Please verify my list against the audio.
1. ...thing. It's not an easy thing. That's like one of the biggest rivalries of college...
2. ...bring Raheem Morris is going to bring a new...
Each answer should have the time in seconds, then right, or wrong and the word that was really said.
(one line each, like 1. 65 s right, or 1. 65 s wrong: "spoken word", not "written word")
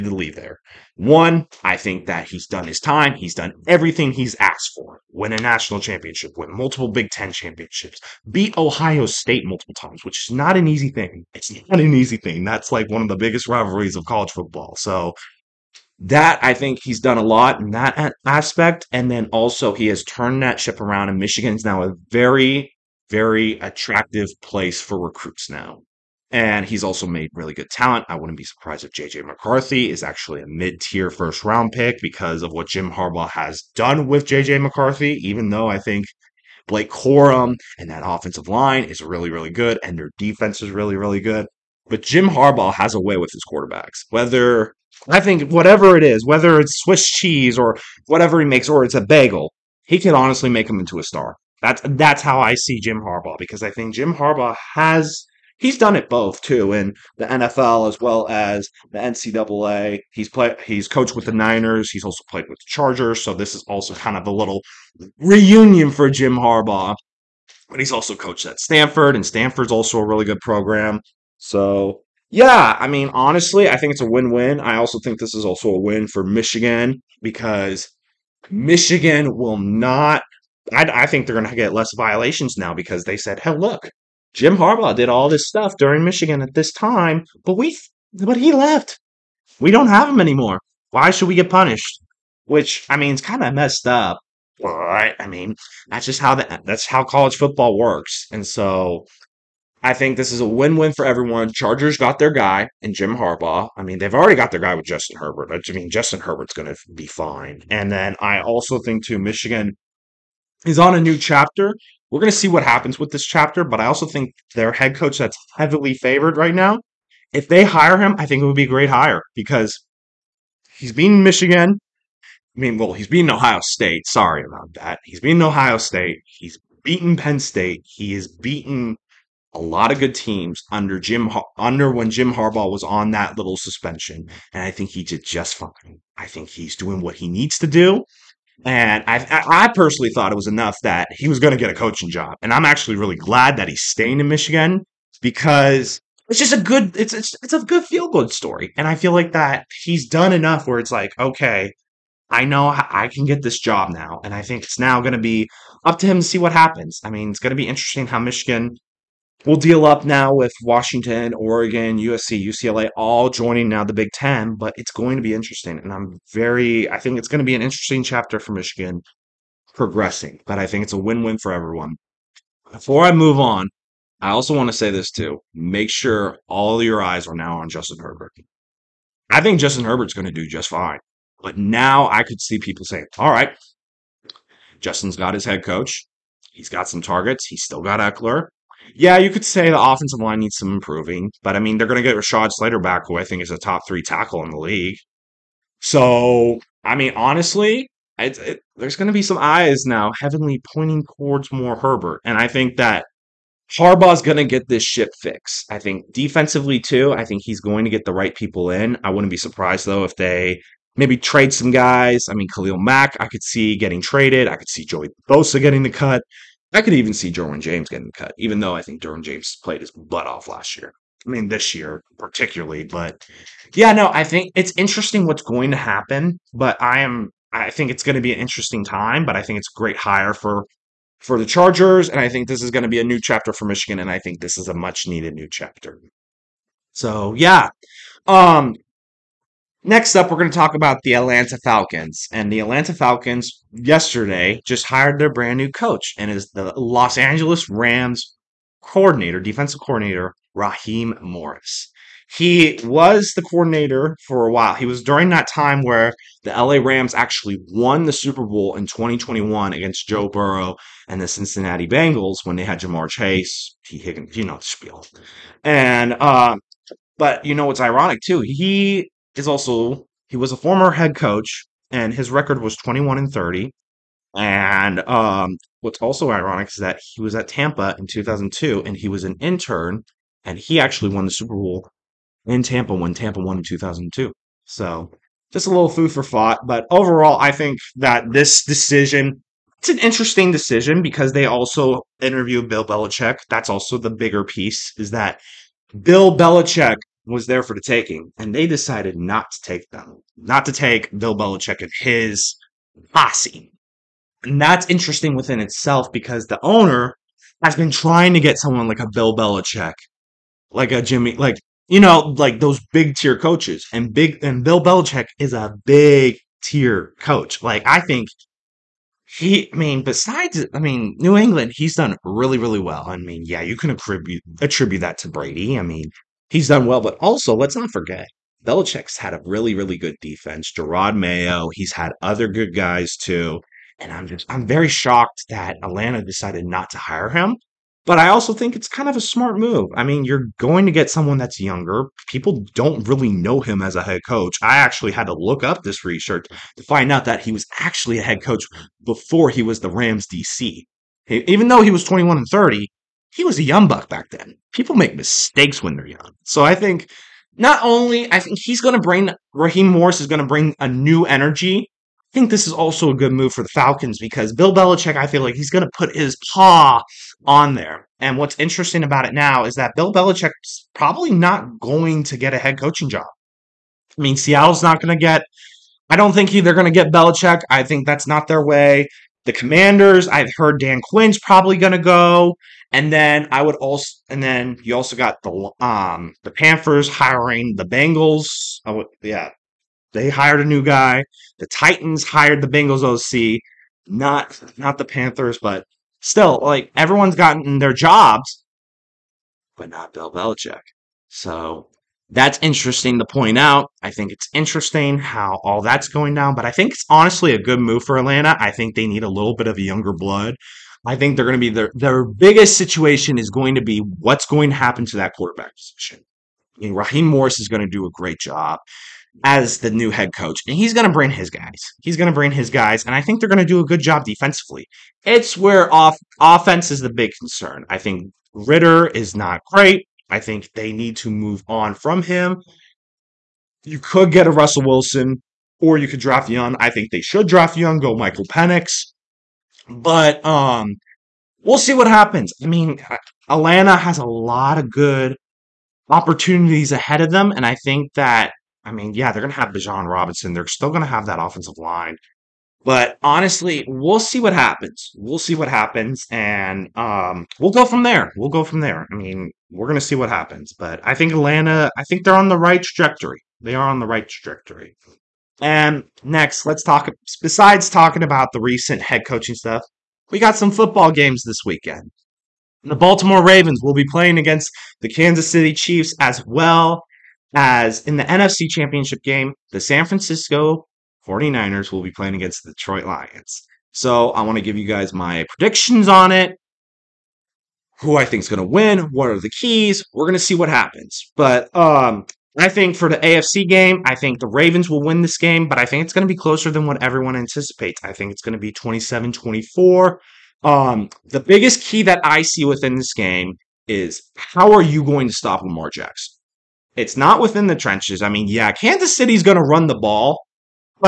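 1. 10 s right
2. 358 s right.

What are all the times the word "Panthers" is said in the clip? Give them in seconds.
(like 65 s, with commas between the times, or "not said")
386 s, 395 s.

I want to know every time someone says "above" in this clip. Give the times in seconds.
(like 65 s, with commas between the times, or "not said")
not said.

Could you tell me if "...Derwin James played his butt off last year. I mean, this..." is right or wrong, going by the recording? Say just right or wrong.
right.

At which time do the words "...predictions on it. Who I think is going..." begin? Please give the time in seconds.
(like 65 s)
485 s.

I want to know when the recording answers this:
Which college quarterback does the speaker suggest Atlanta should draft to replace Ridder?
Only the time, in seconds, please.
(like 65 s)
438 s.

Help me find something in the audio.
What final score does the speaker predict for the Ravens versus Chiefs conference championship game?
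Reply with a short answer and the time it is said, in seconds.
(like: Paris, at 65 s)
27-24, at 498 s.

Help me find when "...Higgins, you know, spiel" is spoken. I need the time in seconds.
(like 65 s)
263 s.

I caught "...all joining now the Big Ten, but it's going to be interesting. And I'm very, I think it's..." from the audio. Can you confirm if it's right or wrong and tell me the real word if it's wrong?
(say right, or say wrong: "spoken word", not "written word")
right.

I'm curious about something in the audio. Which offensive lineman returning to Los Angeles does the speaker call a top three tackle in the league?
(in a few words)
Rashawn Slater.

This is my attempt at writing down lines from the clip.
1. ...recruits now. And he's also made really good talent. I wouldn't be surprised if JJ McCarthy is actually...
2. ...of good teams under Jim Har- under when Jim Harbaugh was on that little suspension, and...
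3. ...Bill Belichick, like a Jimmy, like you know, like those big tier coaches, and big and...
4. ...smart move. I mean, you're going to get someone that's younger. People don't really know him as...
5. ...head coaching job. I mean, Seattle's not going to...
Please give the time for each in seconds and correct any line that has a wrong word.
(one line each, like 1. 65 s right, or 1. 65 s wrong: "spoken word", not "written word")
1. 24 s right
2. 129 s right
3. 309 s right
4. 339 s right
5. 372 s right.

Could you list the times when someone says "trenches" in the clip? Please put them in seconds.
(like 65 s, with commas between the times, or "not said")
507 s.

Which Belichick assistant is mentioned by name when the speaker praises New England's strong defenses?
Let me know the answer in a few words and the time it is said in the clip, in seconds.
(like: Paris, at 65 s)
Jerod Mayo, at 330 s.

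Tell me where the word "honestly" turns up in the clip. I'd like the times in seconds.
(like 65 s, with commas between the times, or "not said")
50 s, 73 s, 197 s, 407 s, 453 s.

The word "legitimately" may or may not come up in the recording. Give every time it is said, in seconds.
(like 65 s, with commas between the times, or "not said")
not said.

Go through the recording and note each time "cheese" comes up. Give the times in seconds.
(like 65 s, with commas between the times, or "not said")
47 s.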